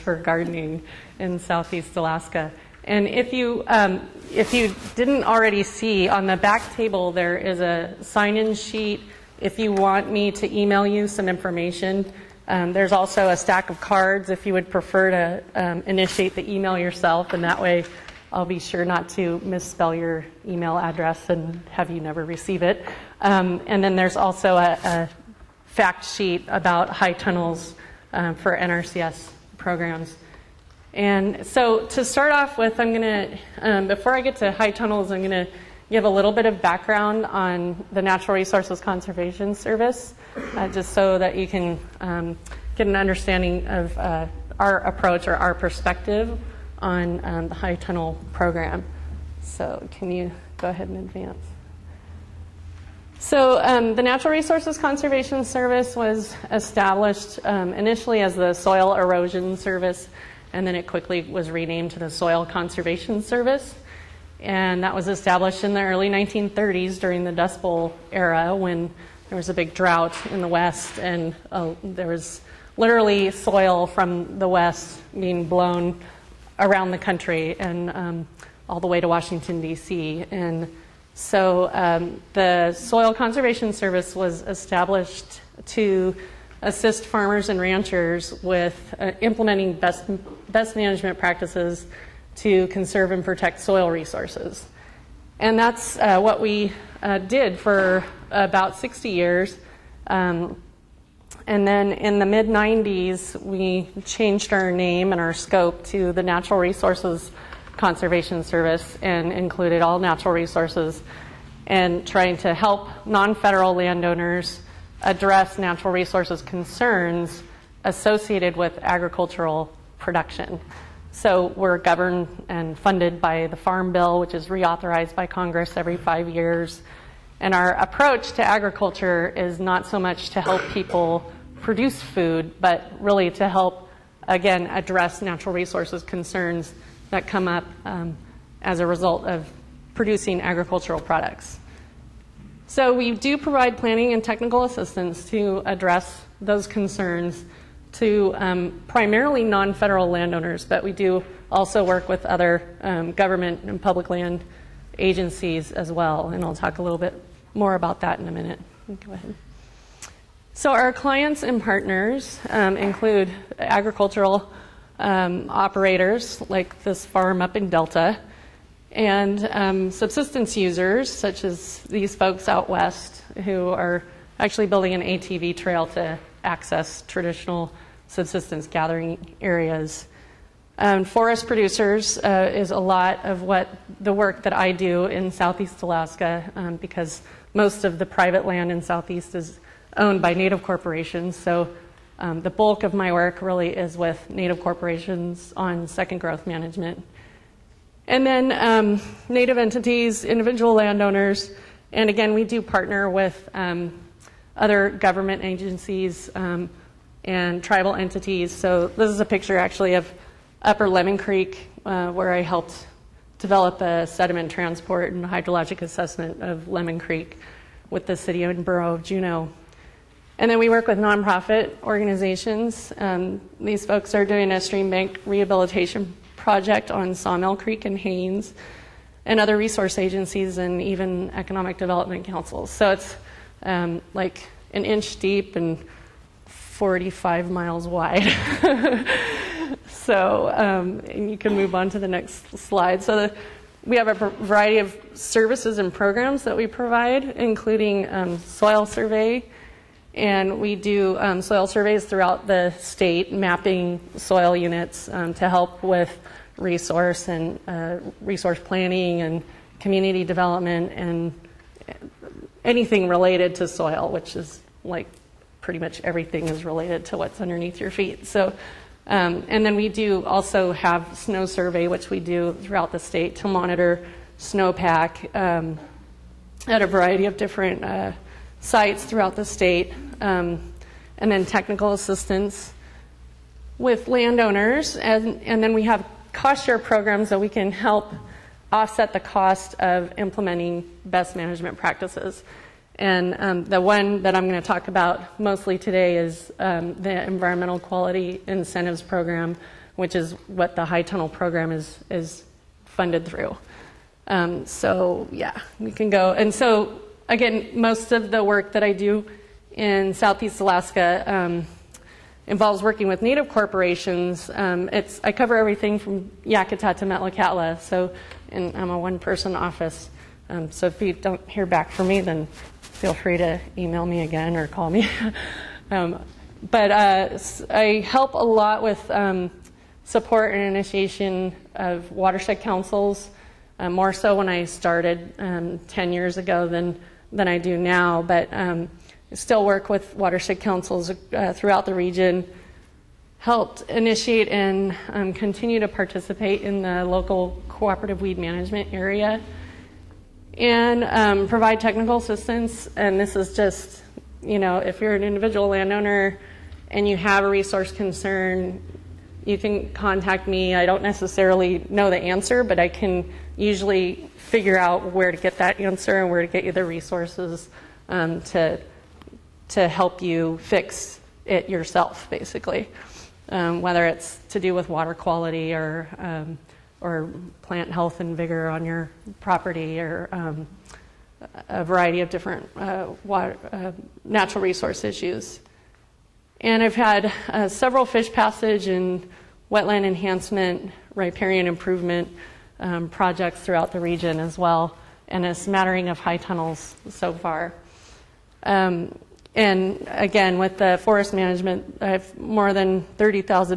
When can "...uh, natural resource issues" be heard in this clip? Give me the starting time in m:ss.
6:23.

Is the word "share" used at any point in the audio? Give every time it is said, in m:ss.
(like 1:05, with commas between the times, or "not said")
4:46.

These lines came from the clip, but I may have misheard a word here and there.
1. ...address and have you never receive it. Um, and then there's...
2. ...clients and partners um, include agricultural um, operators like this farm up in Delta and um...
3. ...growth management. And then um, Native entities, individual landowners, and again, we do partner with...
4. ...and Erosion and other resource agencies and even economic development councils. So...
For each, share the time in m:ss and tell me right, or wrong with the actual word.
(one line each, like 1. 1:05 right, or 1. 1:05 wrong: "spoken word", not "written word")
1. 0:20 right
2. 2:40 right
3. 3:16 right
4. 3:47 wrong: "Haines", not "Erosion".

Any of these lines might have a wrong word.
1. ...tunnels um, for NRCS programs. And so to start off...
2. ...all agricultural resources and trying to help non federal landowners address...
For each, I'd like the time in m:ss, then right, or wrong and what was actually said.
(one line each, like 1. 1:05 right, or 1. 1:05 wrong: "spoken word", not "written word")
1. 0:27 right
2. 1:49 wrong: "natural", not "agricultural".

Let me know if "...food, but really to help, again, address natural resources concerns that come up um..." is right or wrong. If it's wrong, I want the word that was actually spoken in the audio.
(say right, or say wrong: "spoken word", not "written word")
right.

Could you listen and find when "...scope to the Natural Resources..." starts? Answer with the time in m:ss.
1:45.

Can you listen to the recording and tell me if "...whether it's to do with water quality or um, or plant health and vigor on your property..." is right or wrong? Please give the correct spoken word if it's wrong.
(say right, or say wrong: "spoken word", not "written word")
right.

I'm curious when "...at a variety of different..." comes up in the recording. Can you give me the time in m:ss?
4:36.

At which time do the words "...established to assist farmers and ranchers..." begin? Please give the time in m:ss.
1:24.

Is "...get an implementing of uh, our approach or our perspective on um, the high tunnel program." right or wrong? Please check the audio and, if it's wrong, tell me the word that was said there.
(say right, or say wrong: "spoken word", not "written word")
wrong: "understanding", not "implementing".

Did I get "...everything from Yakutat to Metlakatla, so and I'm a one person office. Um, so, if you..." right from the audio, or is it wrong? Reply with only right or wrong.
right.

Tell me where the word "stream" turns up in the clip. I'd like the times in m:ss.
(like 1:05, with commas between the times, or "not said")
3:44.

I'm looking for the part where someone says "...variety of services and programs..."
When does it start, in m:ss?
4:04.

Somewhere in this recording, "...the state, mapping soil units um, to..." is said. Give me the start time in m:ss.
4:12.